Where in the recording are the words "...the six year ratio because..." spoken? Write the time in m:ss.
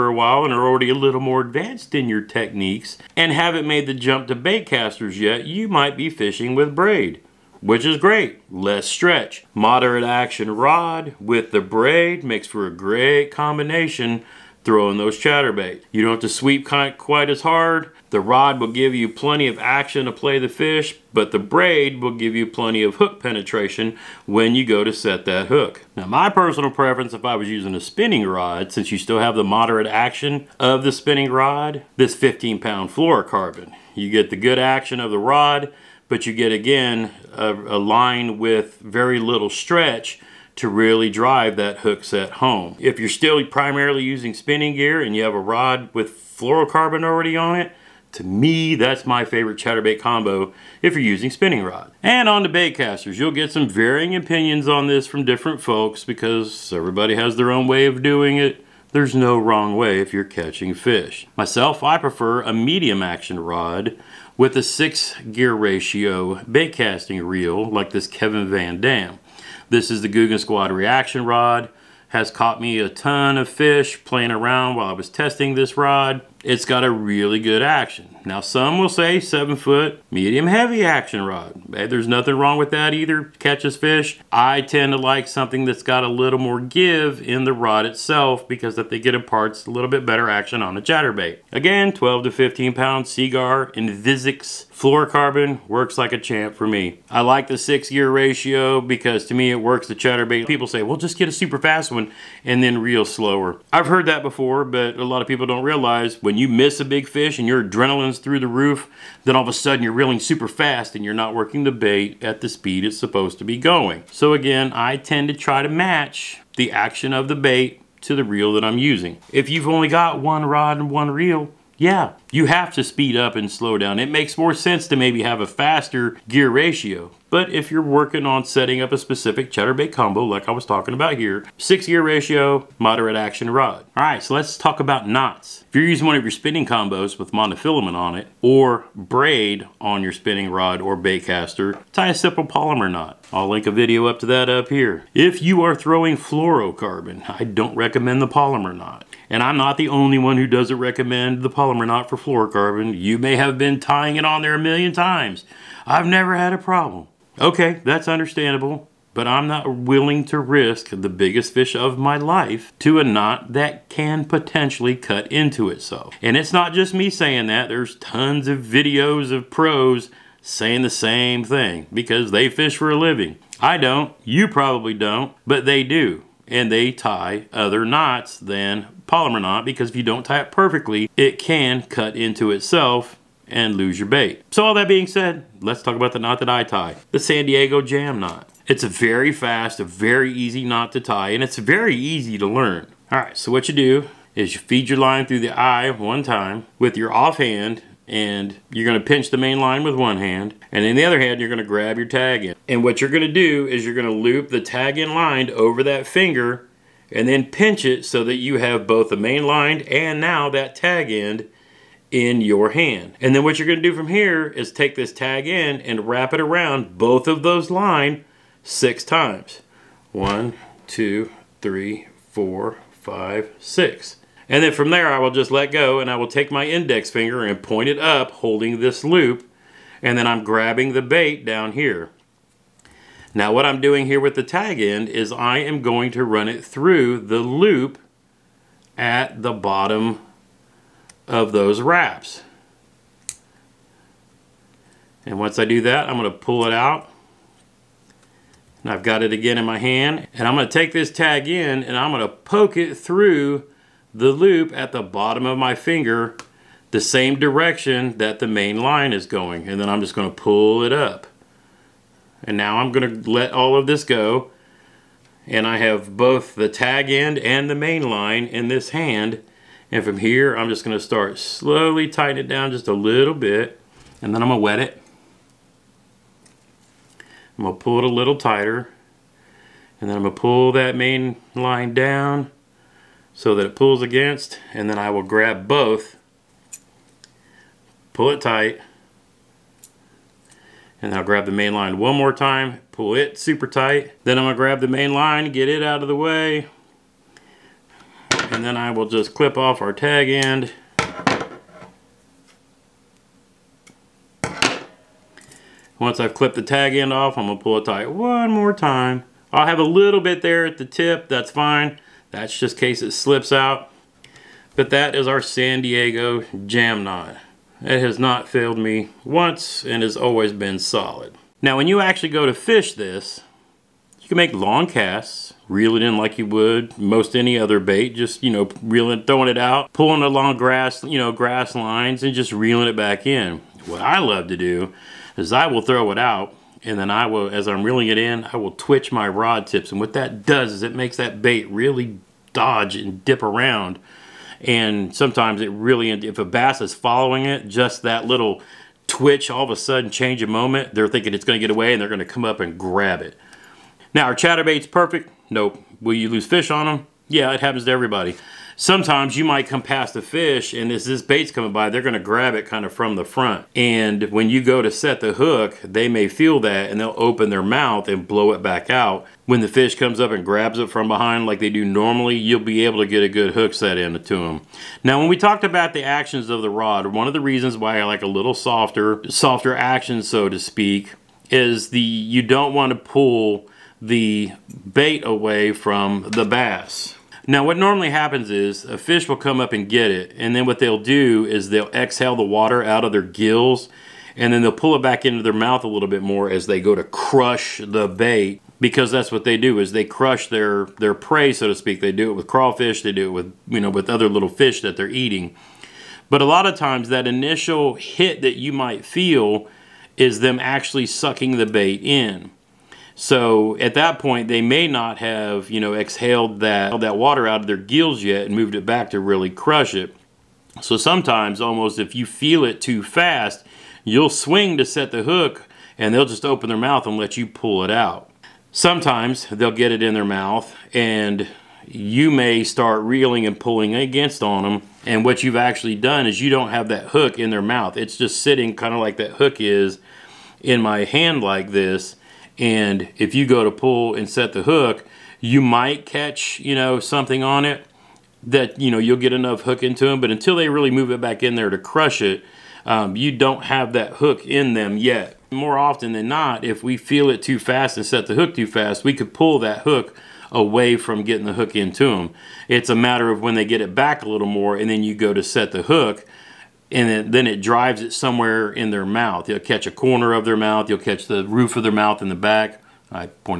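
1:37.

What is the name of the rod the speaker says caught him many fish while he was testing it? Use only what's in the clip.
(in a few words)
Googan Squad reaction rod.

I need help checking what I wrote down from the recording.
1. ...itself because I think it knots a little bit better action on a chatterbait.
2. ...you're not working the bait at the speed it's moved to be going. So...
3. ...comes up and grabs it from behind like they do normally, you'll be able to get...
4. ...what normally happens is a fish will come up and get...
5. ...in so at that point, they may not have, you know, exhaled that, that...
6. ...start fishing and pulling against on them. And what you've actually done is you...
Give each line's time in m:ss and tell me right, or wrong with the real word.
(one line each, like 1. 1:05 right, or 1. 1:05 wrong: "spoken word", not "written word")
1. 1:27 wrong: "imparts", not "knots"
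2. 1:51 wrong: "supposed", not "moved"
3. 6:09 right
4. 6:27 right
5. 6:52 right
6. 7:12 wrong: "reeling", not "fishing".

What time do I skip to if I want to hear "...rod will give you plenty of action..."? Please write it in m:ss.
0:18.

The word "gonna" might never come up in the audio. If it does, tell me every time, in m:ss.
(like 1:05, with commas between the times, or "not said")
5:07, 6:02.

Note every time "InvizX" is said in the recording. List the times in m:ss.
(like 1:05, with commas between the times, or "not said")
1:33.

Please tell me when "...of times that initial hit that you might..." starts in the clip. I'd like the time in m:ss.
6:46.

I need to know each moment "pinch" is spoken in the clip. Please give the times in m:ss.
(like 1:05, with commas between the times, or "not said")
3:19, 3:27.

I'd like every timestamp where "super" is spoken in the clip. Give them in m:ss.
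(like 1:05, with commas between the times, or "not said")
1:41, 1:50, 4:53.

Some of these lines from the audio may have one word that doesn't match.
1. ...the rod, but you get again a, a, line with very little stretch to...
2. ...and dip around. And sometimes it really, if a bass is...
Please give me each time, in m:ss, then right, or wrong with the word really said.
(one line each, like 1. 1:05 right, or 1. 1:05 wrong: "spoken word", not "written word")
1. 0:35 right
2. 5:42 right.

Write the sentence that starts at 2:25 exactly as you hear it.
If you are throwing fluorocarbon, I don't recommend the Palomar knot.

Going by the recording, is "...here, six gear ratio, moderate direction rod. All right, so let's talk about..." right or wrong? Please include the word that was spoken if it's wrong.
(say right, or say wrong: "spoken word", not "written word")
wrong: "action", not "direction".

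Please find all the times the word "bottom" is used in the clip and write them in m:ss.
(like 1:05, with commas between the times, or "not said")
3:59, 4:15.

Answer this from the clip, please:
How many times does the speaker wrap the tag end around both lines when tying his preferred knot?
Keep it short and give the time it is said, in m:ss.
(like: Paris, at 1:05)
6, at 3:38.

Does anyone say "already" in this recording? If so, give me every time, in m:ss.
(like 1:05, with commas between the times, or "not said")
0:00, 0:47.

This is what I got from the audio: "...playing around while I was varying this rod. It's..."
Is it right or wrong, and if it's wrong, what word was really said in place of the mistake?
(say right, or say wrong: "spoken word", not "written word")
wrong: "testing", not "varying".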